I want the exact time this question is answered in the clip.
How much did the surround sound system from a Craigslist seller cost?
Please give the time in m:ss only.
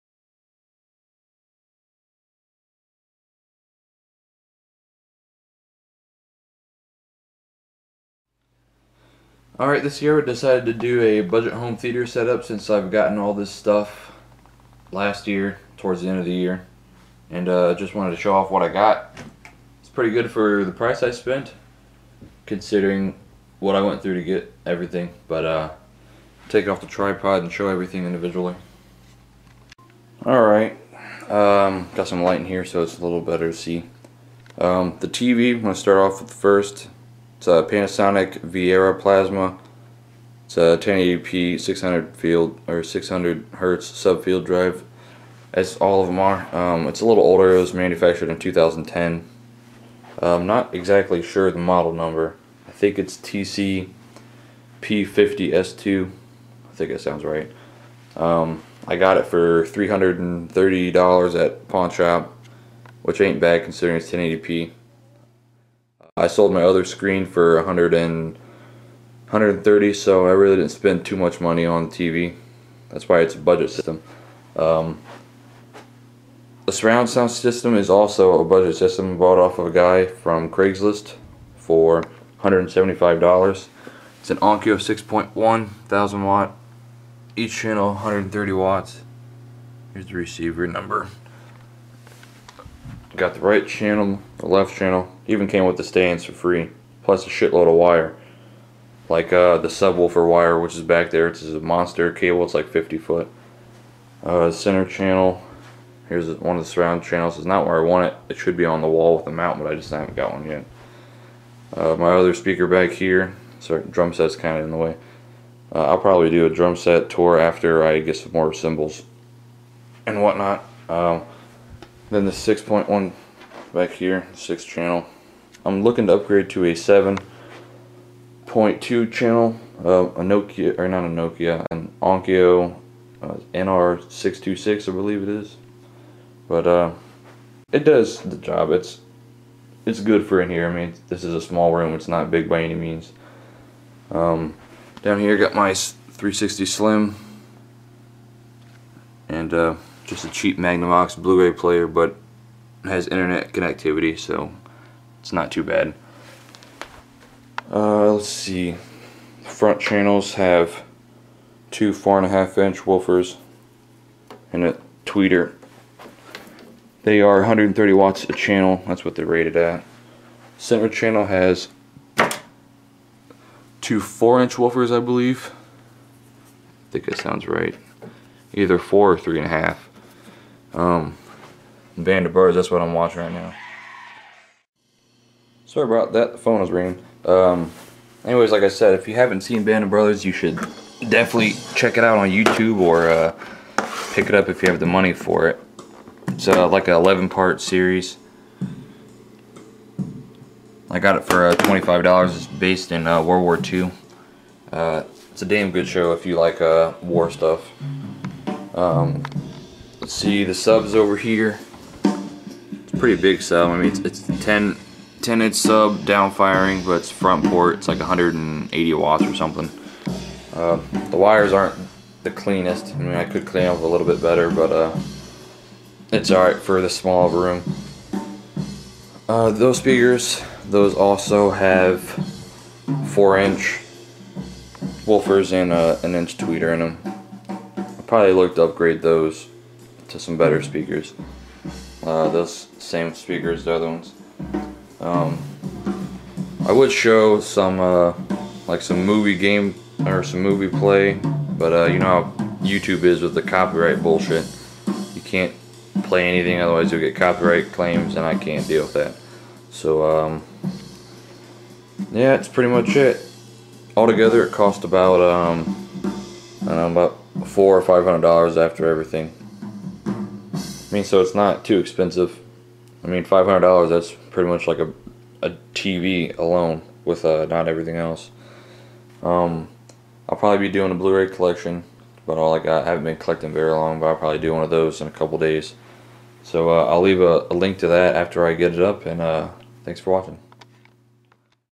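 1:22.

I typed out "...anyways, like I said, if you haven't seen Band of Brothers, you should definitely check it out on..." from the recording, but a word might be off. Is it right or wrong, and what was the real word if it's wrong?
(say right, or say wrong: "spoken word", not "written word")
right.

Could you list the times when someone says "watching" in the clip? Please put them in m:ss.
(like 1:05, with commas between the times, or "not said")
3:02, 4:50.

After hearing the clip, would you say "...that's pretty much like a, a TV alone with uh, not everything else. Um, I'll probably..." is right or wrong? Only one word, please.
right.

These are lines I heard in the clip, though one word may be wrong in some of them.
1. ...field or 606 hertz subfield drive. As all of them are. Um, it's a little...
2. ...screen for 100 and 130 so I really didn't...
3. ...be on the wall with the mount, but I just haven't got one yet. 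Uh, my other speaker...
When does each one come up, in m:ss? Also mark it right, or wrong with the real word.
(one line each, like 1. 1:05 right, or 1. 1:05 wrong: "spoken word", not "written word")
1. 0:42 wrong: "600", not "606"
2. 1:06 right
3. 1:48 right.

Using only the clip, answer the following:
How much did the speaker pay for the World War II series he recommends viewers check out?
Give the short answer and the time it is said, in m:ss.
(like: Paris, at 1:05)
$25, at 3:21.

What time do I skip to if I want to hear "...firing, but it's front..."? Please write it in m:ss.
3:36.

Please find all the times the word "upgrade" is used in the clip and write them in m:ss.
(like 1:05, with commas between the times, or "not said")
2:06, 3:58.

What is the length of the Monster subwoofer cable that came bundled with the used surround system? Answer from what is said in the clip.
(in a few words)
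50 foot.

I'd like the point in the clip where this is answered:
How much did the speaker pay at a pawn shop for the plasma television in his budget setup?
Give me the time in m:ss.
0:59.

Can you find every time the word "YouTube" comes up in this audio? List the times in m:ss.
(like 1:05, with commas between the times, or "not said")
3:12, 4:12.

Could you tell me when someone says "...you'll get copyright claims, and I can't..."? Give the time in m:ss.
4:16.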